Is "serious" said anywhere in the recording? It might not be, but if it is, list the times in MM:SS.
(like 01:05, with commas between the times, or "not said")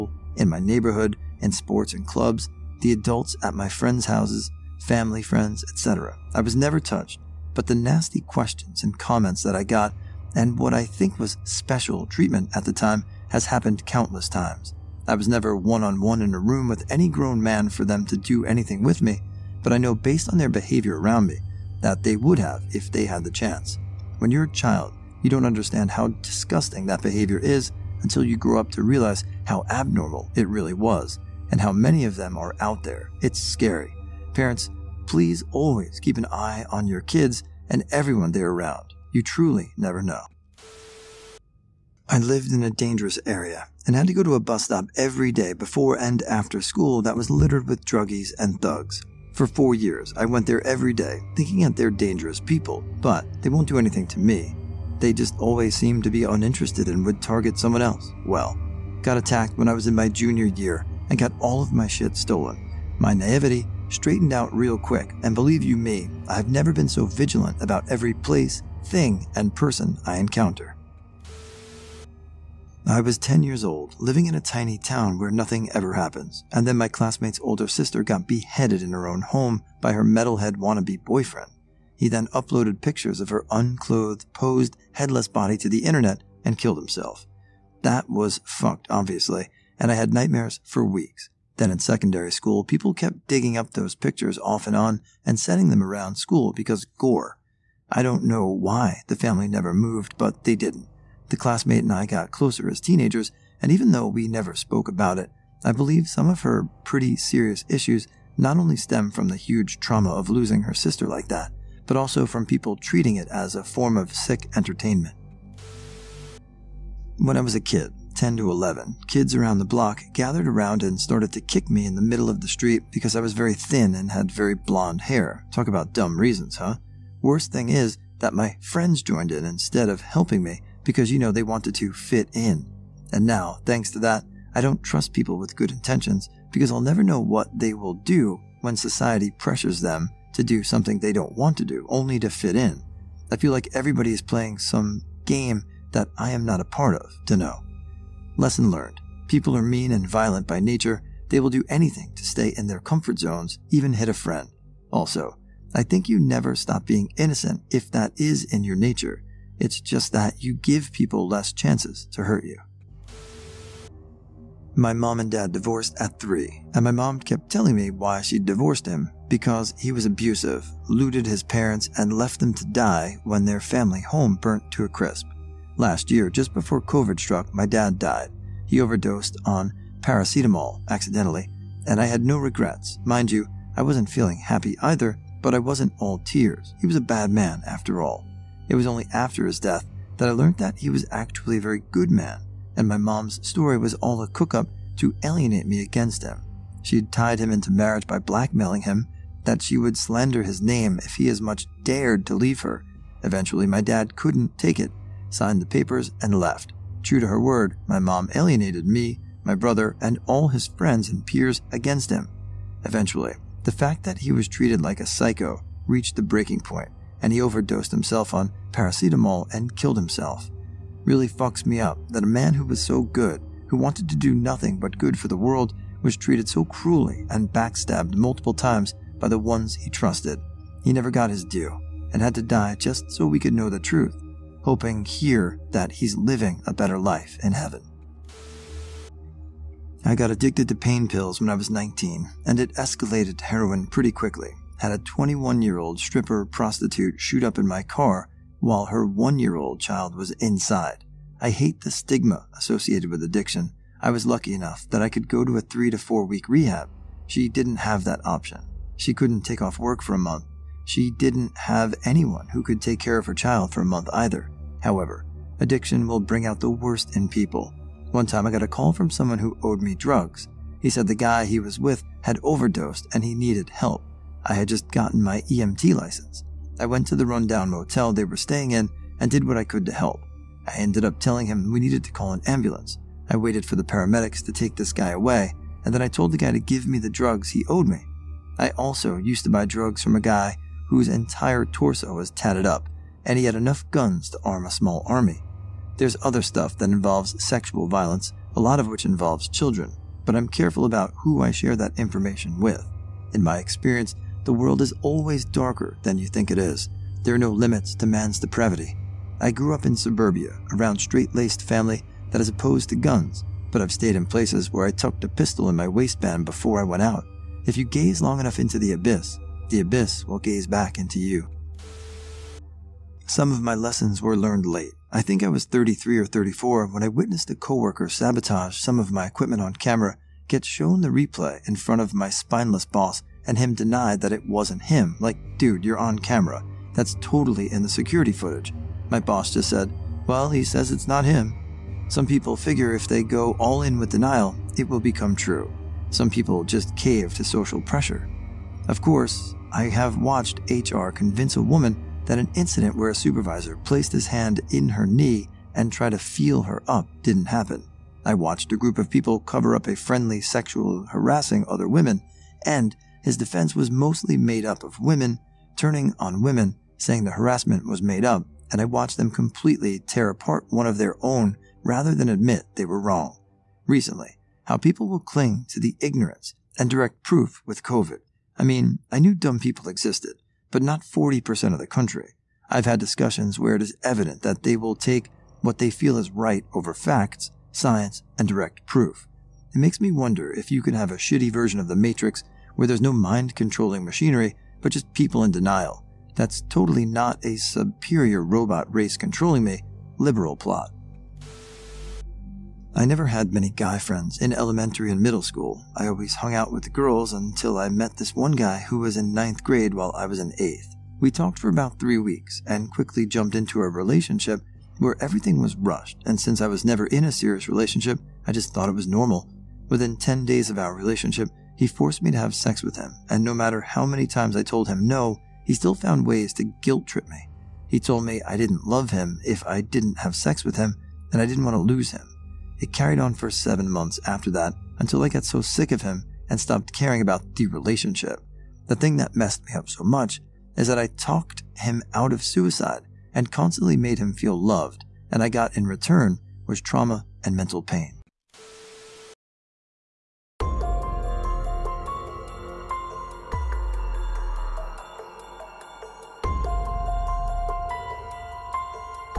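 01:47, 06:57.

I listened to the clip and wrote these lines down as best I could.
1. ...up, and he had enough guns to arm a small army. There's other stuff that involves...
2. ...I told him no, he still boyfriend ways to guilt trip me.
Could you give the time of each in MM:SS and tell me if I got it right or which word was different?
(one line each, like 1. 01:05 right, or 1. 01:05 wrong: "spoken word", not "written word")
1. 04:52 right
2. 07:04 wrong: "found", not "boyfriend".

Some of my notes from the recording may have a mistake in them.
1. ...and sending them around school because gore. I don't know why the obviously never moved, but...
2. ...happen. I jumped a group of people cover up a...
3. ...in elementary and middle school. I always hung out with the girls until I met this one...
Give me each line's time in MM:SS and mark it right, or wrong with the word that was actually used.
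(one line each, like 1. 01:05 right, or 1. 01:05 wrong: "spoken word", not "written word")
1. 01:35 wrong: "family", not "obviously"
2. 05:57 wrong: "watched", not "jumped"
3. 06:44 right.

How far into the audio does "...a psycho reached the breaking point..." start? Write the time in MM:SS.
03:34.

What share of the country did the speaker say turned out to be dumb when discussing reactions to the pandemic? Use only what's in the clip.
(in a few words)
40%.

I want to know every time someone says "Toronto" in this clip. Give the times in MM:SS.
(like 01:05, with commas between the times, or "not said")
not said.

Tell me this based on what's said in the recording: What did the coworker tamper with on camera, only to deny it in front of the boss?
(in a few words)
Equipment.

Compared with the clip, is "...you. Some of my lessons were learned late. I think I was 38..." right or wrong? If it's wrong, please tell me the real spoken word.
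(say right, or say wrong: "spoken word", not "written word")
wrong: "33", not "38".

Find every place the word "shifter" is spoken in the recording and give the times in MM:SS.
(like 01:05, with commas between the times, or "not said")
not said.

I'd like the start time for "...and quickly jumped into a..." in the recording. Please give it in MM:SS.
06:52.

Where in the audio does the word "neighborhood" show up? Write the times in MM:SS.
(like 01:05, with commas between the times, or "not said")
00:00.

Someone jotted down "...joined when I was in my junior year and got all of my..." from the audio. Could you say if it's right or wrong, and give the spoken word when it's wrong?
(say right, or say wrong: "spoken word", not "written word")
wrong: "attacked", not "joined".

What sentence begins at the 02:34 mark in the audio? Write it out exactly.
Also, I think you never stop being innocent if that is in your nature.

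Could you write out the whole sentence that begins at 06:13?
Recently, how people will cling to the ignorance and direct proof with COVID.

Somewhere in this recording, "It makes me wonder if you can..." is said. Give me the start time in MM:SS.
06:29.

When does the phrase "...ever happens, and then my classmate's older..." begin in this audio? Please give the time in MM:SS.
01:15.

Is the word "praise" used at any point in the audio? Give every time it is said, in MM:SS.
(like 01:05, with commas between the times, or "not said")
not said.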